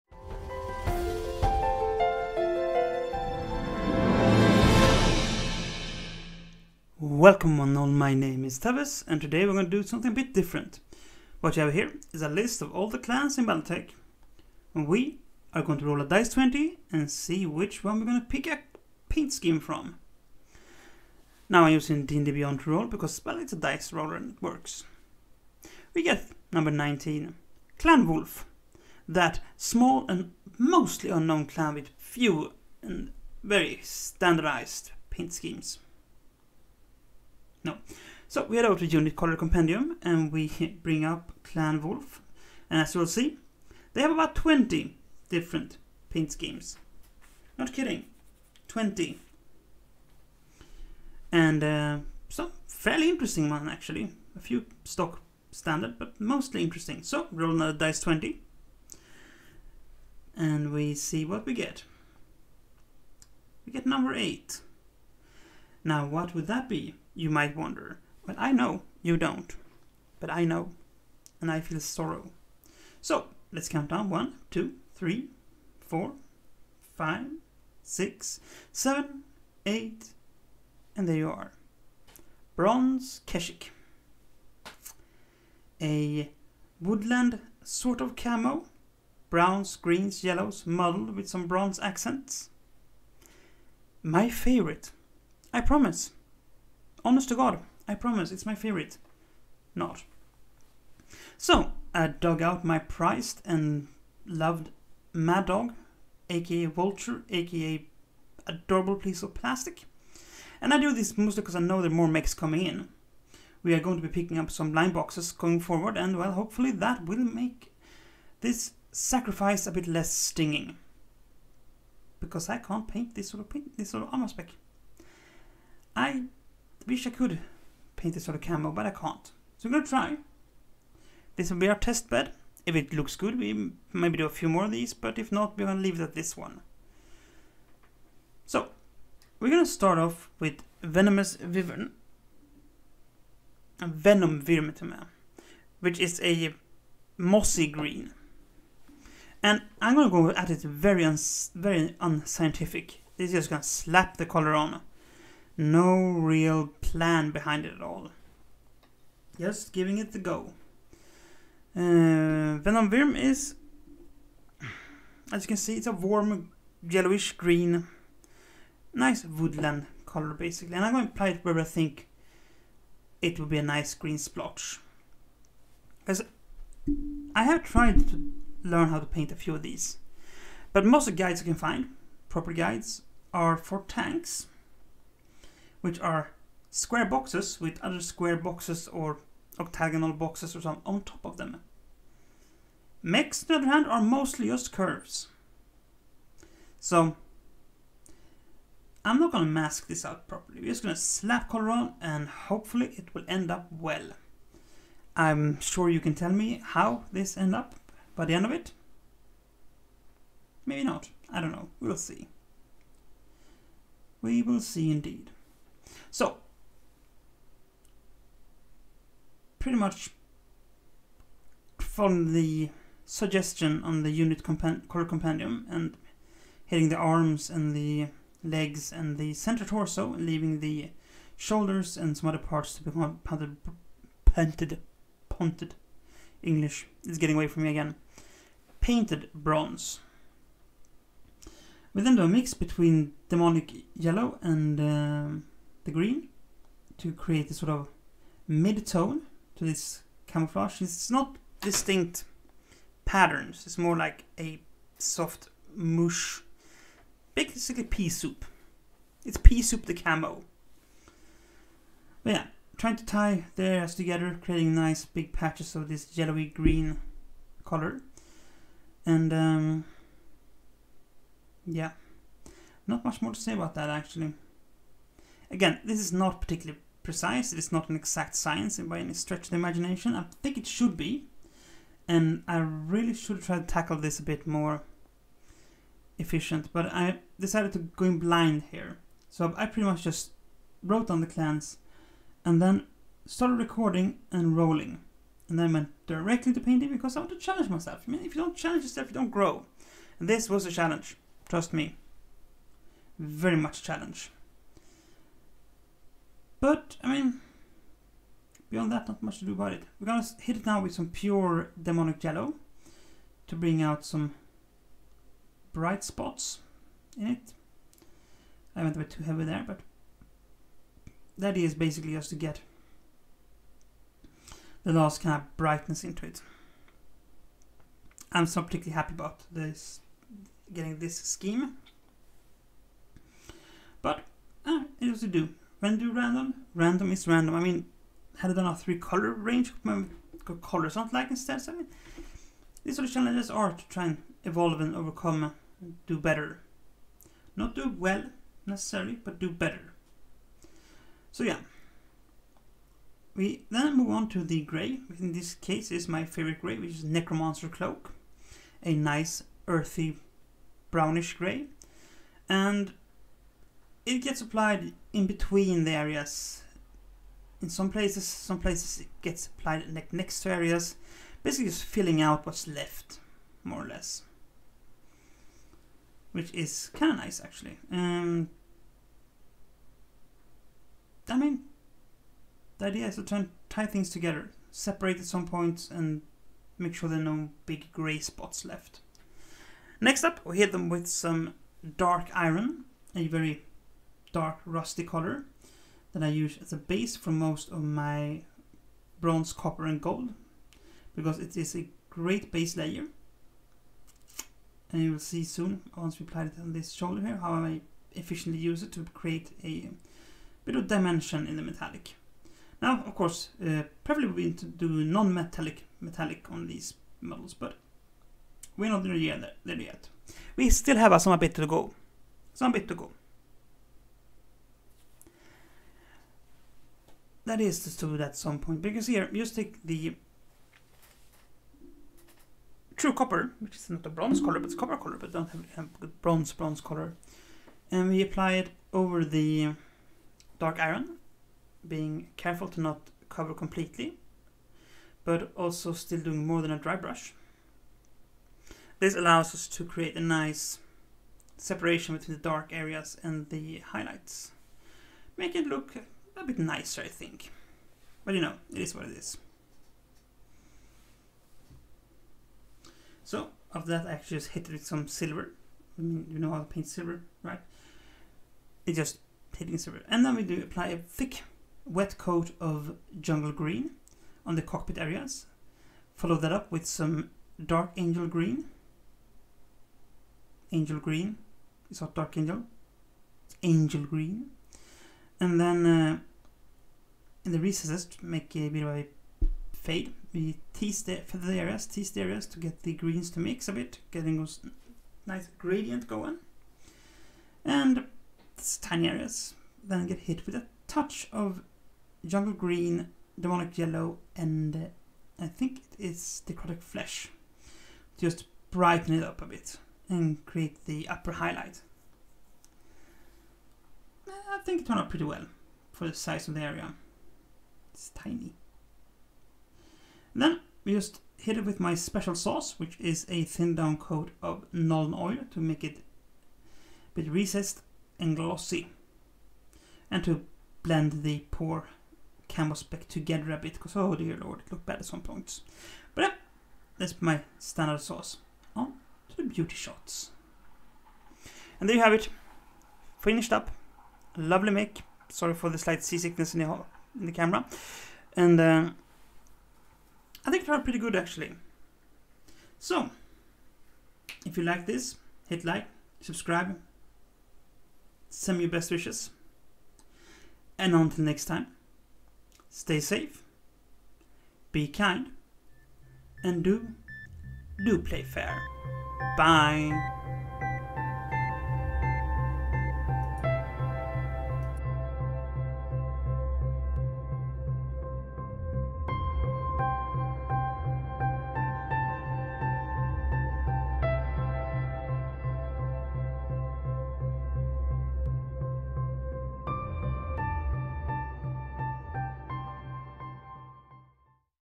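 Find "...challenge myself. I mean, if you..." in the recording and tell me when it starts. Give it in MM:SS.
04:57.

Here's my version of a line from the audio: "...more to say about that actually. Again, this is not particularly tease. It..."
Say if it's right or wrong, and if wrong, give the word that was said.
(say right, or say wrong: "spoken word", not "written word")
wrong: "precise", not "tease".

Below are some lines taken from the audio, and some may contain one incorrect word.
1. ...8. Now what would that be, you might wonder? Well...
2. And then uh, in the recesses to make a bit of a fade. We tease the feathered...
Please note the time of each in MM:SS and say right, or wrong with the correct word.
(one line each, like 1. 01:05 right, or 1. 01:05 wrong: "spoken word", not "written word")
1. 01:04 right
2. 08:05 right.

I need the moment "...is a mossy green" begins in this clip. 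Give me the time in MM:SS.
02:25.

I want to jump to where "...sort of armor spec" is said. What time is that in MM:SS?
02:03.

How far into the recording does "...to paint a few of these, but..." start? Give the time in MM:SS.
02:58.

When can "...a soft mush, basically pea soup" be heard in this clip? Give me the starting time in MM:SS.
04:14.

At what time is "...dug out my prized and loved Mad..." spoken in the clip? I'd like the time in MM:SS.
01:42.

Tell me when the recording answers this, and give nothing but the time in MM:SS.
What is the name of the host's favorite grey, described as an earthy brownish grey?
05:57.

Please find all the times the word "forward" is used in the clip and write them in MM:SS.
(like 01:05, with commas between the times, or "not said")
01:55.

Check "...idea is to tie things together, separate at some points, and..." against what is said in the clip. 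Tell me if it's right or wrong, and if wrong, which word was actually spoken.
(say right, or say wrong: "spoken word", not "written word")
right.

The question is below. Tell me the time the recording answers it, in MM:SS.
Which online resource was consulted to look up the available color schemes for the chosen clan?
00:38.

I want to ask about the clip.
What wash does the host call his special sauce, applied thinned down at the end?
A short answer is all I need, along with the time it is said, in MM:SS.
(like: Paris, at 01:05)
Nuln Oil, at 08:44.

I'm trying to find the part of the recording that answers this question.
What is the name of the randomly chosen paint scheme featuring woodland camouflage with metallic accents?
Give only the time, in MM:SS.
01:22.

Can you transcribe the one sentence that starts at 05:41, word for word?
So I mean, these sort of challenges are to try and evolve and overcome, and do better.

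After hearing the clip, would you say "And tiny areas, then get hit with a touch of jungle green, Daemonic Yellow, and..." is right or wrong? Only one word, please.
right.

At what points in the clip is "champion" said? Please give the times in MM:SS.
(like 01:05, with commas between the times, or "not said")
not said.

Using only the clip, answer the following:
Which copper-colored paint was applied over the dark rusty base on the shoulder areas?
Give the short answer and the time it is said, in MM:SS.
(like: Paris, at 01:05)
True Copper, at 07:12.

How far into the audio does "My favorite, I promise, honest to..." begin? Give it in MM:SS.
01:34.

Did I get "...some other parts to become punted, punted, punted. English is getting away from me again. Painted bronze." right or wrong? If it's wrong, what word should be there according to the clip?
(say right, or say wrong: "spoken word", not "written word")
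right.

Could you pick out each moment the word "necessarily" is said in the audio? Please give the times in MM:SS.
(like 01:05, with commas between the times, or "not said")
05:48.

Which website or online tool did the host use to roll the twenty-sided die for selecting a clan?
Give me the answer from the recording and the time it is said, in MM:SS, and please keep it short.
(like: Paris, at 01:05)
D&D Beyond, at 00:22.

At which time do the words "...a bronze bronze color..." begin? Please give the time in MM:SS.
07:16.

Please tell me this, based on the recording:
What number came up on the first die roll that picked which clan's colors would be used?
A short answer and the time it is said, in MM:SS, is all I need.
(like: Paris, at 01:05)
19, at 00:26.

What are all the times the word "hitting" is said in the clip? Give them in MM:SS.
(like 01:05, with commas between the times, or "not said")
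03:46, 07:49.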